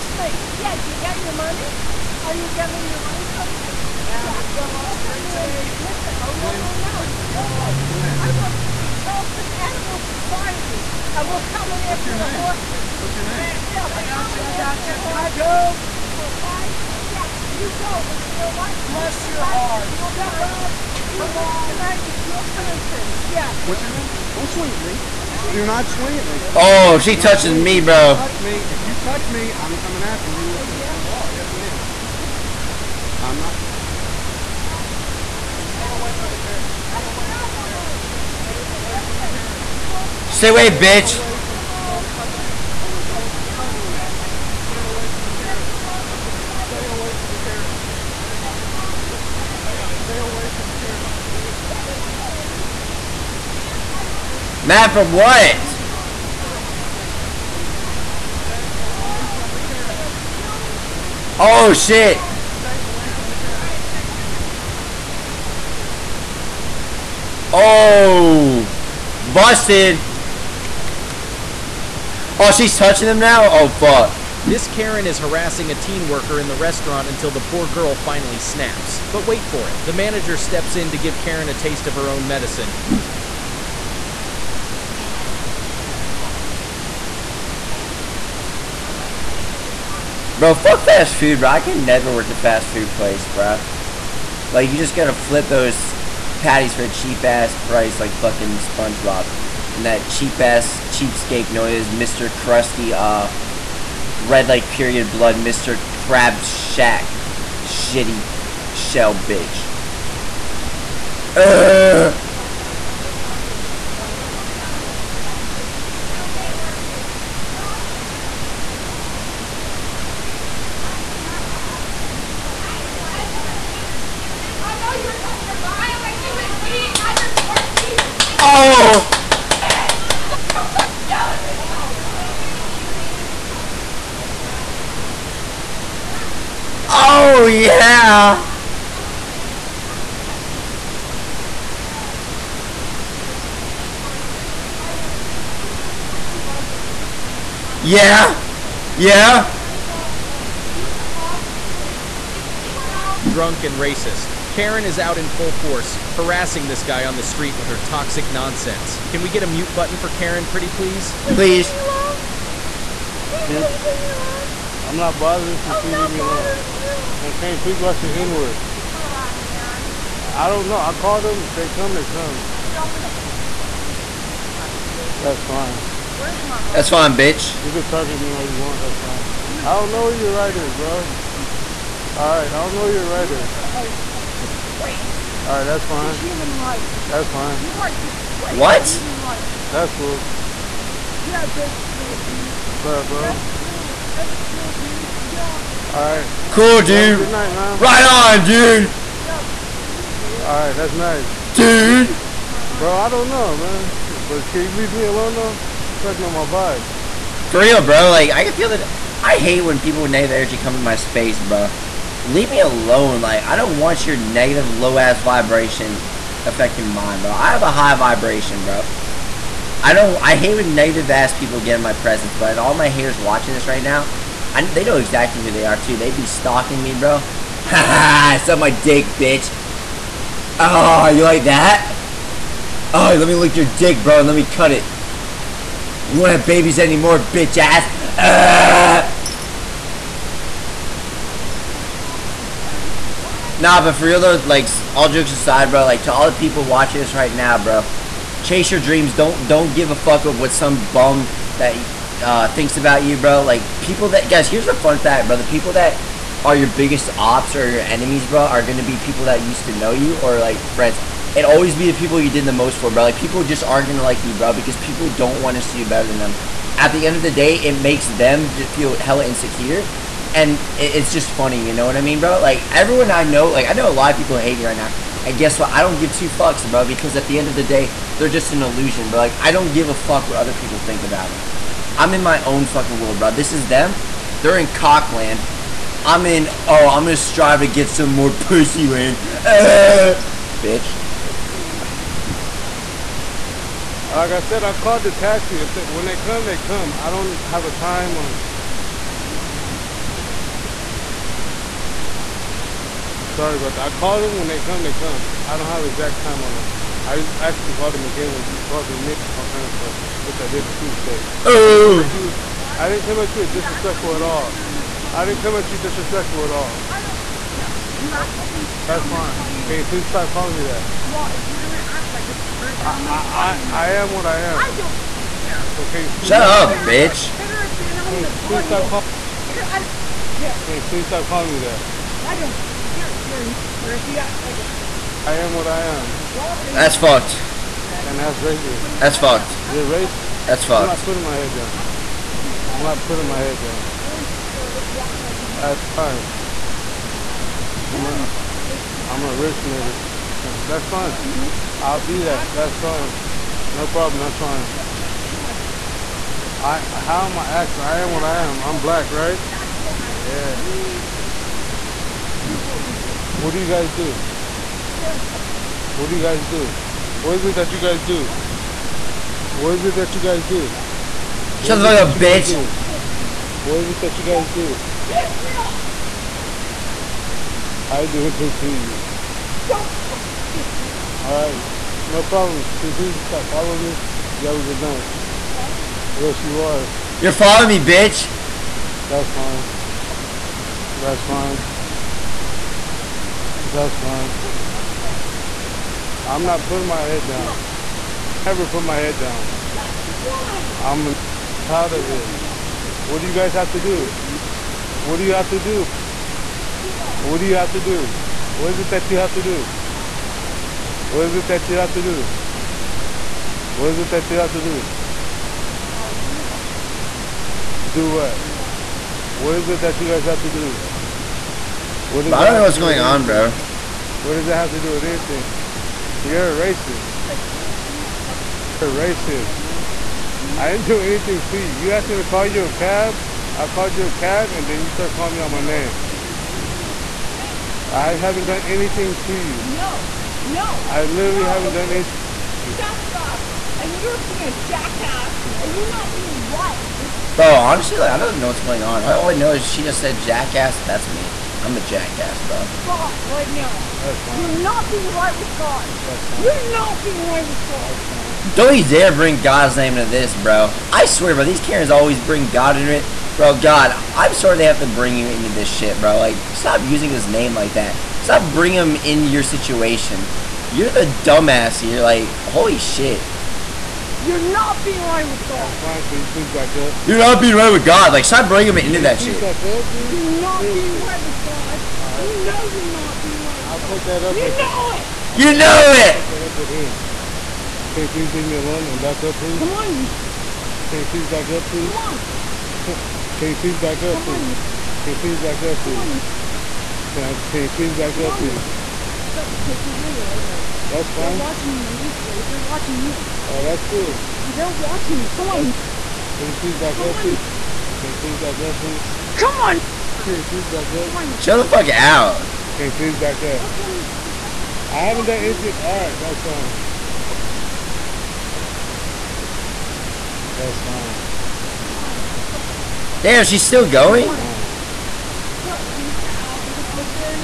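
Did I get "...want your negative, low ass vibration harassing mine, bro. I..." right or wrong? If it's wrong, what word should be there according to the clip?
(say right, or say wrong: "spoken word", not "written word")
wrong: "affecting", not "harassing".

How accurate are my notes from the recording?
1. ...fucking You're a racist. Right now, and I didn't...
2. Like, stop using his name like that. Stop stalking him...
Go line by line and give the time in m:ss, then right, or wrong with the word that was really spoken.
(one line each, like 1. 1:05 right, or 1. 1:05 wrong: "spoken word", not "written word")
1. 7:08 right
2. 7:46 wrong: "bringing", not "stalking".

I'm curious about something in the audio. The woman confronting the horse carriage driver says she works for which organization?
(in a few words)
Charleston Animal Society.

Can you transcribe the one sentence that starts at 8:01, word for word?
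Alright, You know you're not being right with I'll God.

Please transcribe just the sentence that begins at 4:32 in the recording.
Like everyone I know, like I know a lot of people hate me right now, and guess what?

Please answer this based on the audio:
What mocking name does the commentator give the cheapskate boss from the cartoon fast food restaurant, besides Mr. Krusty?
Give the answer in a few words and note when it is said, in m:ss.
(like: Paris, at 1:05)
Mr. Crab Shack, at 1:45.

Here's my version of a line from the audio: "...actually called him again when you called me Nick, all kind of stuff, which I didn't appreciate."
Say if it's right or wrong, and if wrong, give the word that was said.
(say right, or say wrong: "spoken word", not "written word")
right.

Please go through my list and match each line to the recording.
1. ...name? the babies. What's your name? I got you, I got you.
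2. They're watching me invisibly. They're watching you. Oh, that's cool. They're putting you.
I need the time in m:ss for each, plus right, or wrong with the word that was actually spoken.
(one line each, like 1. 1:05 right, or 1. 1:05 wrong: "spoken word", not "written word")
1. 0:12 wrong: "horses", not "babies"
2. 8:21 wrong: "watching", not "putting".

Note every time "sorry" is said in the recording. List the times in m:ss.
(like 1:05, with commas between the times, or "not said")
5:03, 7:44.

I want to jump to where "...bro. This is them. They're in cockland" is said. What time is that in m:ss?
4:43.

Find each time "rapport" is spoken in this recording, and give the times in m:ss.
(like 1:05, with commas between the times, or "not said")
not said.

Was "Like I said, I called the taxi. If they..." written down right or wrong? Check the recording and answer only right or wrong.
right.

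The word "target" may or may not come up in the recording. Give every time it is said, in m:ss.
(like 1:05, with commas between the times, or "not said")
2:53, 2:57.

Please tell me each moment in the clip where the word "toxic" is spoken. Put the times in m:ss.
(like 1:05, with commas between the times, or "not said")
2:37.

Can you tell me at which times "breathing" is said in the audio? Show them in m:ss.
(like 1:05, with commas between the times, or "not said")
not said.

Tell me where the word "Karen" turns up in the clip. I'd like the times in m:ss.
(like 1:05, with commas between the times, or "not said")
1:14, 1:21, 2:34, 2:40, 7:41.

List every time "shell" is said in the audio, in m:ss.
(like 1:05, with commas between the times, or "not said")
1:48.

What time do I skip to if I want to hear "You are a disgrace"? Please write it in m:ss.
3:07.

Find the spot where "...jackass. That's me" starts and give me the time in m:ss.
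7:30.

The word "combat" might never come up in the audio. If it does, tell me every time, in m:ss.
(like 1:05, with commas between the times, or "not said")
not said.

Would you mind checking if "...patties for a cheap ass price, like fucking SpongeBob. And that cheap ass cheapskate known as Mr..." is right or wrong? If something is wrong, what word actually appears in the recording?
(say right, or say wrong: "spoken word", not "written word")
right.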